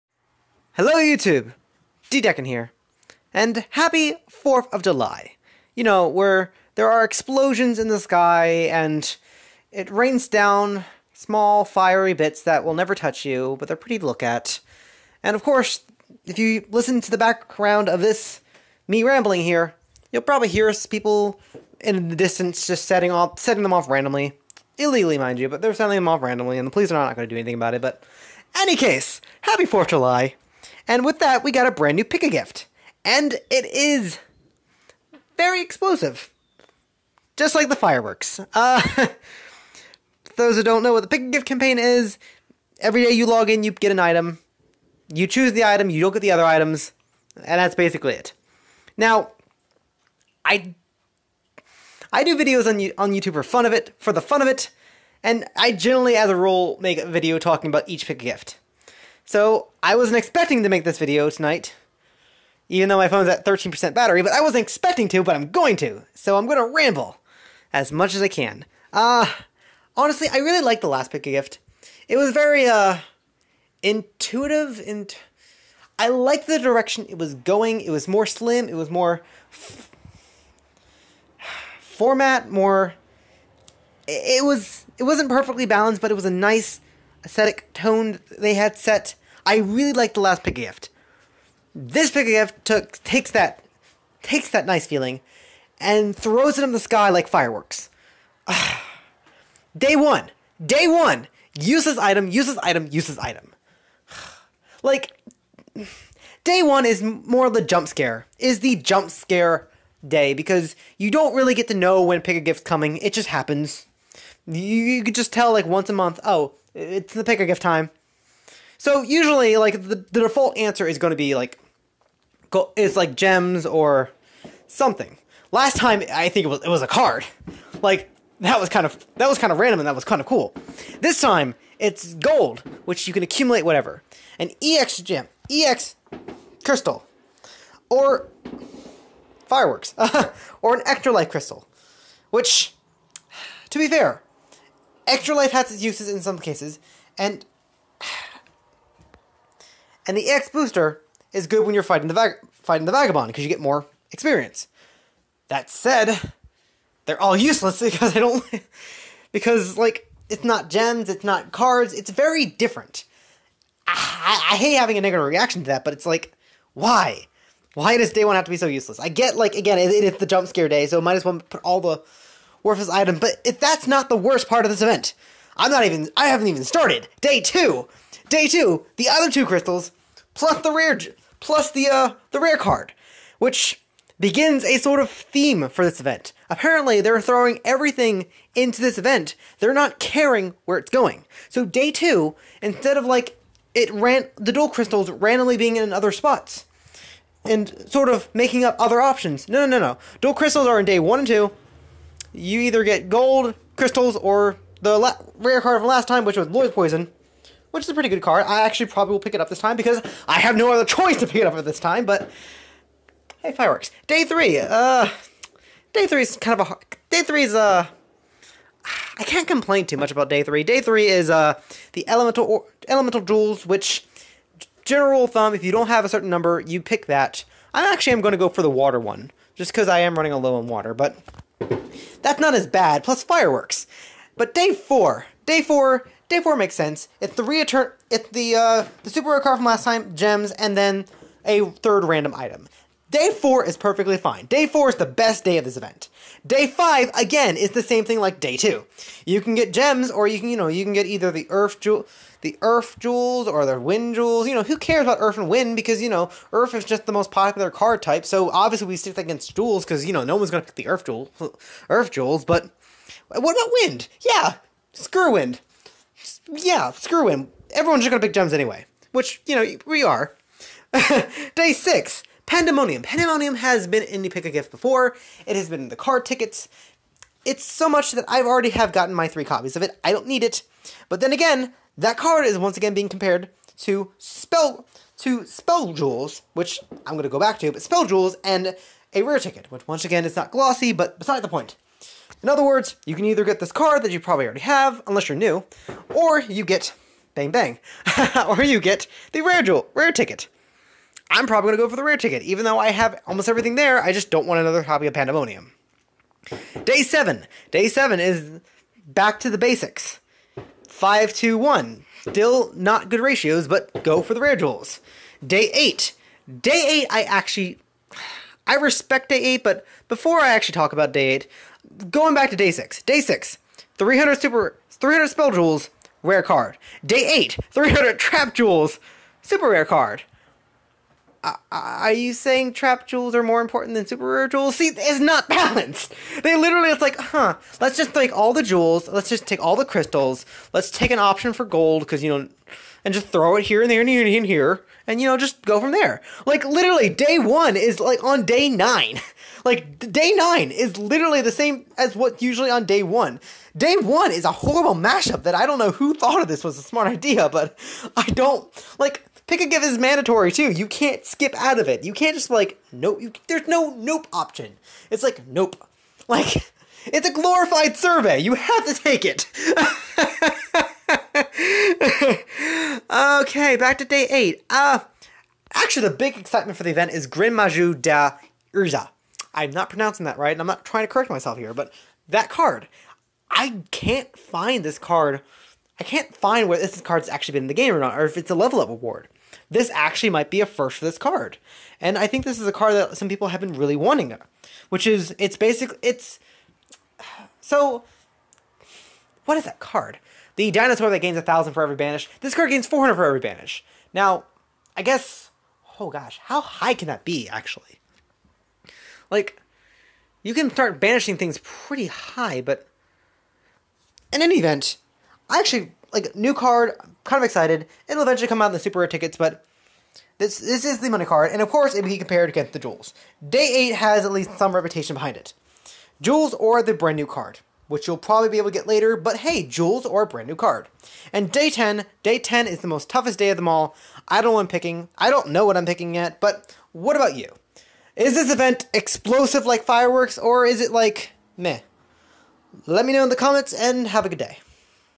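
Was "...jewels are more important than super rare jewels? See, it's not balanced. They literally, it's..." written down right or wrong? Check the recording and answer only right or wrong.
right.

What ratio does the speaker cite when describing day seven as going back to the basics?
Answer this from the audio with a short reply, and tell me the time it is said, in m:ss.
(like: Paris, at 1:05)
5 to 1, at 5:10.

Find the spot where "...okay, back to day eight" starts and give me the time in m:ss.
6:13.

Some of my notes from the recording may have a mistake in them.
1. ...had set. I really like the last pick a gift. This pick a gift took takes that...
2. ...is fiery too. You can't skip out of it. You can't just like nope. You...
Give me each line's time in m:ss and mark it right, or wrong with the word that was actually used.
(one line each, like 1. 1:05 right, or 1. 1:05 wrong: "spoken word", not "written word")
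1. 1:28 right
2. 5:59 wrong: "mandatory", not "fiery".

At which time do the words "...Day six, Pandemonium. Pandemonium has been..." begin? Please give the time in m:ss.
4:31.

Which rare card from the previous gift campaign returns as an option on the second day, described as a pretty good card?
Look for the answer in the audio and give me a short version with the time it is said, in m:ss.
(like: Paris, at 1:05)
Lord Poison, at 3:26.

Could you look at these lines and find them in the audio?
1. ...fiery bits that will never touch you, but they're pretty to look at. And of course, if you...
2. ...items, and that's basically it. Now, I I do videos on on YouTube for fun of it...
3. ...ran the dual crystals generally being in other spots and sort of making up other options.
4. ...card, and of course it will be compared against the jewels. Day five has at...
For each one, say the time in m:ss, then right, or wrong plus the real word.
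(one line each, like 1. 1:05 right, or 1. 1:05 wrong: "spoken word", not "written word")
1. 0:11 right
2. 0:46 right
3. 3:13 wrong: "randomly", not "generally"
4. 7:01 wrong: "eight", not "five".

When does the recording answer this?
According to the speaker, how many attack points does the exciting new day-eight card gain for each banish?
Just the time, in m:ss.
6:42.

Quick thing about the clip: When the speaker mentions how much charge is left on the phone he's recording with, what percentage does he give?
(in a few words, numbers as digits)
13%.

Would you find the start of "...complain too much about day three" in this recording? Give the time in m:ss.
3:39.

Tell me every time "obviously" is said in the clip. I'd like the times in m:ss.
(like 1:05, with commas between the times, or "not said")
4:18.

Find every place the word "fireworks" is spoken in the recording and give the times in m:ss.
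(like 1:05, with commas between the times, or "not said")
0:37, 1:37, 2:19, 3:33, 3:53, 7:19.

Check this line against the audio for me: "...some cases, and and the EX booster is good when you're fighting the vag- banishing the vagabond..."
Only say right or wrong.
wrong.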